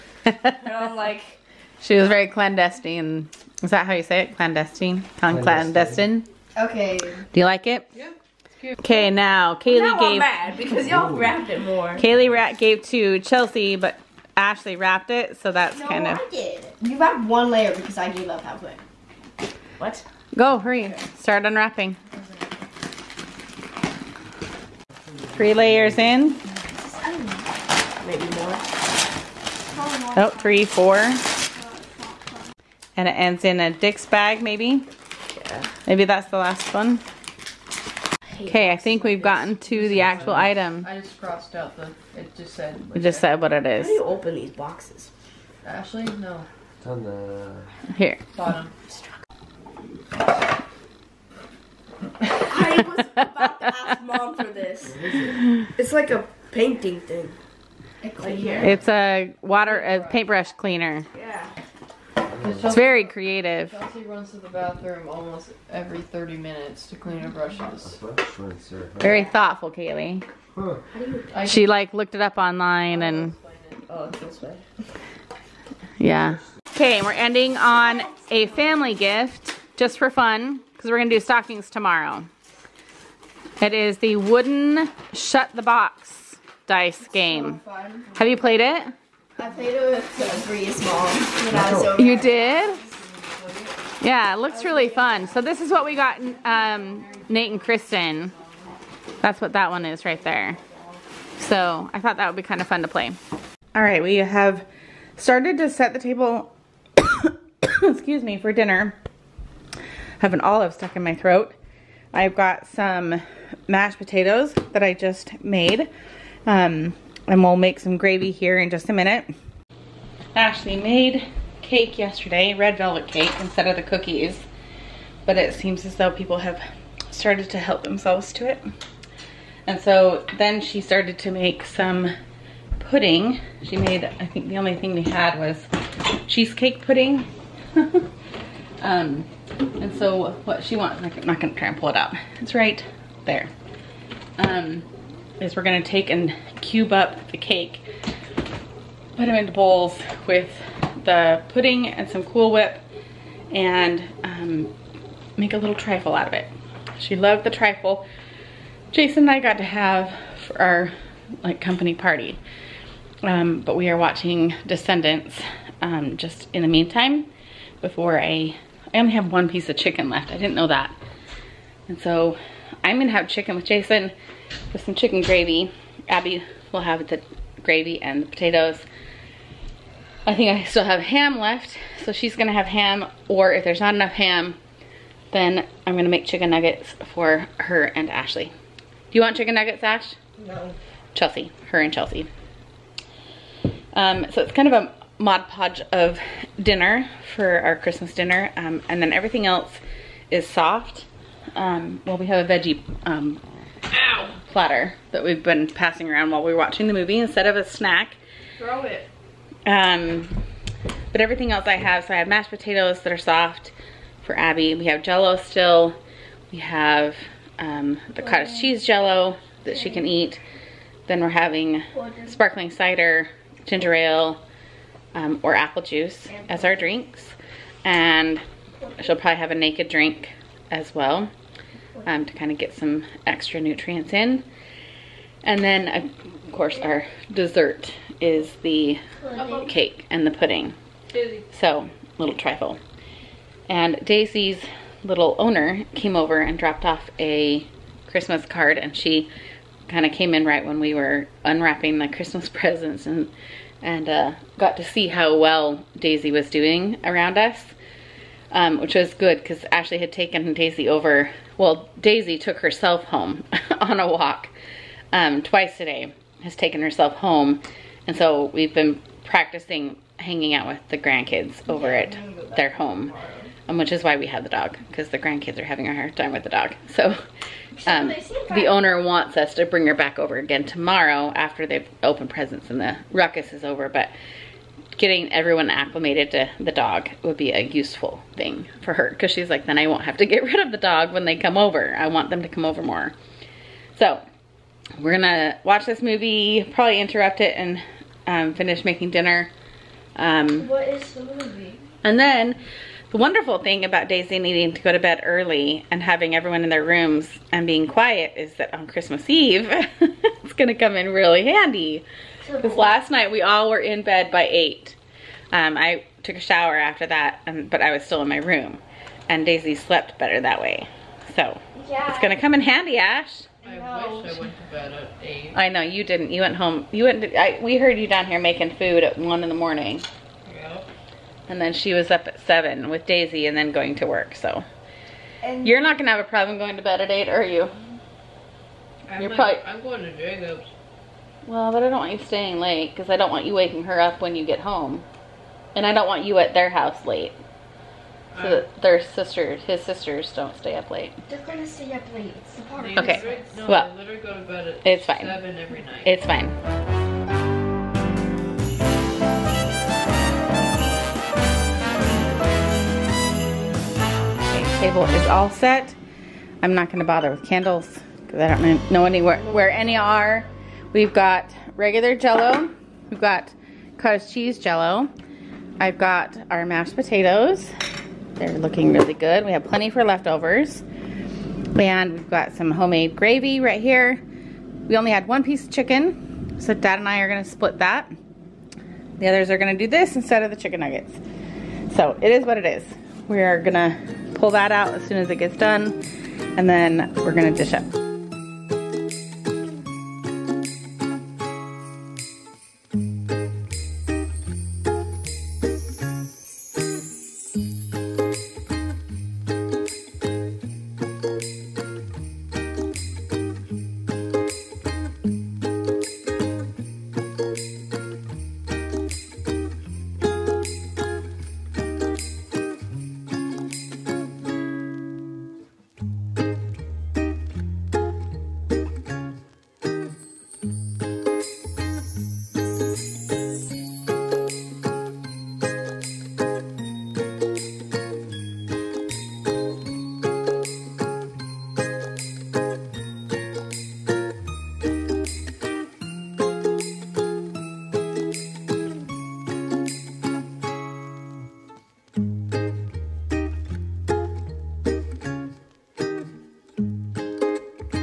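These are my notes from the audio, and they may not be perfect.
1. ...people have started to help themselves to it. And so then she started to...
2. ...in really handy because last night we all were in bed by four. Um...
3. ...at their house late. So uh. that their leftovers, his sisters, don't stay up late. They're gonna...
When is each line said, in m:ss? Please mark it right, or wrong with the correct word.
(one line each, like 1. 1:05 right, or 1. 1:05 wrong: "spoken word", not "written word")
1. 2:06 right
2. 5:10 wrong: "eight", not "four"
3. 5:46 wrong: "sisters", not "leftovers".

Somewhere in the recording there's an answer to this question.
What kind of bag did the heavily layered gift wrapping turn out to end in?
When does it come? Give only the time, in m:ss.
0:33.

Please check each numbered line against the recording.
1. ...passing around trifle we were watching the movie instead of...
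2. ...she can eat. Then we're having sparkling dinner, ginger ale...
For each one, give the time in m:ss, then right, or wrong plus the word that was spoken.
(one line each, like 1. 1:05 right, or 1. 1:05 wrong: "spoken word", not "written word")
1. 3:25 wrong: "while", not "trifle"
2. 3:39 wrong: "cider", not "dinner".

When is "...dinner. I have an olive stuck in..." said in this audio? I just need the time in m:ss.
1:48.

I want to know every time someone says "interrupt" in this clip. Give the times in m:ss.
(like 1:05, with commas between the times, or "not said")
4:57.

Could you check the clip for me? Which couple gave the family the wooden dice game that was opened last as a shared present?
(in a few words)
Nate and Kristen.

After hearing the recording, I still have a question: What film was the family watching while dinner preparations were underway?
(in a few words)
Descendants.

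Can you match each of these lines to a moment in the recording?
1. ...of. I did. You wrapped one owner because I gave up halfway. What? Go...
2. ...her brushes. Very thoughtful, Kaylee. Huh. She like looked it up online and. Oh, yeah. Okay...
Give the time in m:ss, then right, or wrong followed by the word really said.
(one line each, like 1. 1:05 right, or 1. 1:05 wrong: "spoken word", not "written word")
1. 0:16 wrong: "layer", not "owner"
2. 1:07 right.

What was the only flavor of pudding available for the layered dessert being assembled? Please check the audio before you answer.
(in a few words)
cheesecake.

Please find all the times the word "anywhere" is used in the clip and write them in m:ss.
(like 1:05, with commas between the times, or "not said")
6:09.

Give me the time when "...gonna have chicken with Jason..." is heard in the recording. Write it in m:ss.
2:52.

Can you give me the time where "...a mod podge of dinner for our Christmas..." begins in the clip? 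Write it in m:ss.
3:14.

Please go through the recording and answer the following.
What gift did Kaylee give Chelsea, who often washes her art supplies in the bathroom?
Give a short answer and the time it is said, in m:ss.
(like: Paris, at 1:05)
paintbrush cleaner, at 1:00.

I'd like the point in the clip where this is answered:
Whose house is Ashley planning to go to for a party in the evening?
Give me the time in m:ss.
5:40.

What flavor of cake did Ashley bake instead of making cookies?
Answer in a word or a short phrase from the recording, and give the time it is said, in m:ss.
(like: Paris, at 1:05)
red velvet, at 2:02.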